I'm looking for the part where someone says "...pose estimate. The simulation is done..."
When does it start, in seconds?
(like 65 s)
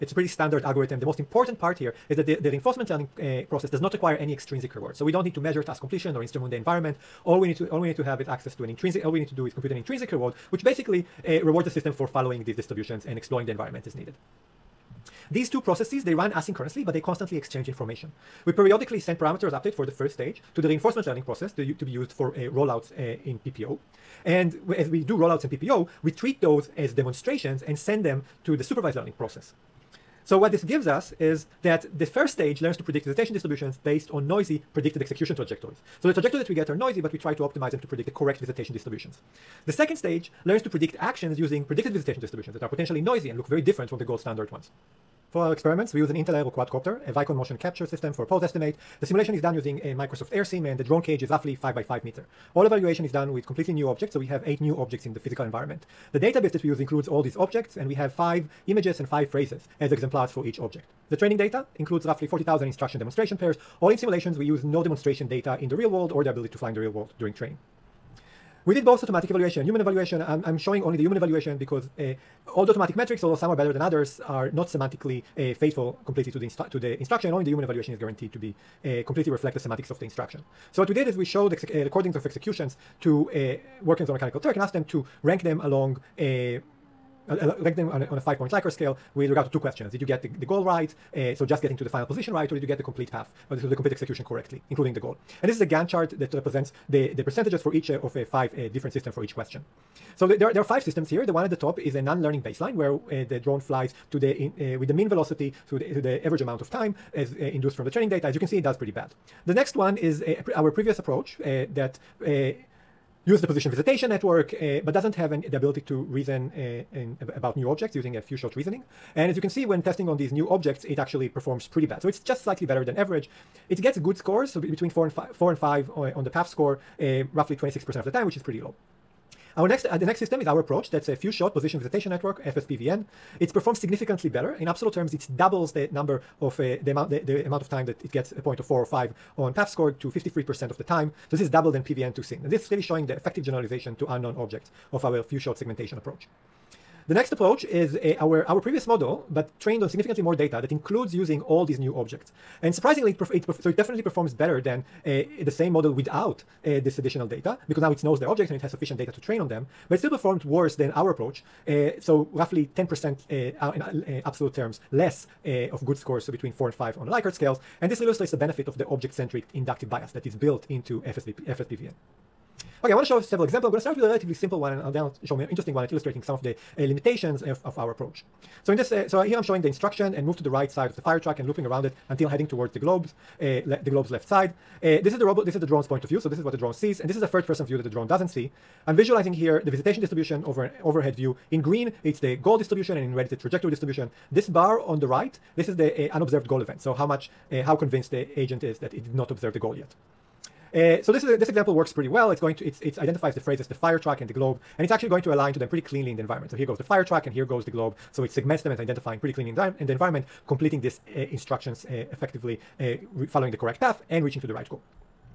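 48 s.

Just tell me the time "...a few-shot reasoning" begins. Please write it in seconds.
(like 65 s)
118 s.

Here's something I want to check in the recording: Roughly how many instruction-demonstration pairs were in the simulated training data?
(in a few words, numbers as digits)
40,000.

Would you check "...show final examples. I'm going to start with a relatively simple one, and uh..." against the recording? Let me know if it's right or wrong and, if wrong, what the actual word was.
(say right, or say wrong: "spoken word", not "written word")
wrong: "several", not "final".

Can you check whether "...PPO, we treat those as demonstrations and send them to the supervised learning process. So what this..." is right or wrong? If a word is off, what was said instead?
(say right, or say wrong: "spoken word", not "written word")
right.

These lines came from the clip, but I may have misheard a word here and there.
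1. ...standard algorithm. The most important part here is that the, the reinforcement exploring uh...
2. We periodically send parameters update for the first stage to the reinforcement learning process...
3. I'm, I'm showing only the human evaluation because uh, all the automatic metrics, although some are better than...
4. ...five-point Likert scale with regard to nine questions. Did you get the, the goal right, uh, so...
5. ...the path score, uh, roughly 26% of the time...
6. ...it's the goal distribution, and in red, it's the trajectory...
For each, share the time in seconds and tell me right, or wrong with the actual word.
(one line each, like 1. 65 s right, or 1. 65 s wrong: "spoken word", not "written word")
1. 0 s wrong: "learning", not "exploring"
2. 18 s right
3. 70 s right
4. 88 s wrong: "two", not "nine"
5. 126 s right
6. 192 s right.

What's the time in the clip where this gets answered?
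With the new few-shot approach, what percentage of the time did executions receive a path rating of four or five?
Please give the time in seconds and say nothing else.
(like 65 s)
140 s.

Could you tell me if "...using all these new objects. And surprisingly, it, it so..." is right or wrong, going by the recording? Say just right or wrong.
right.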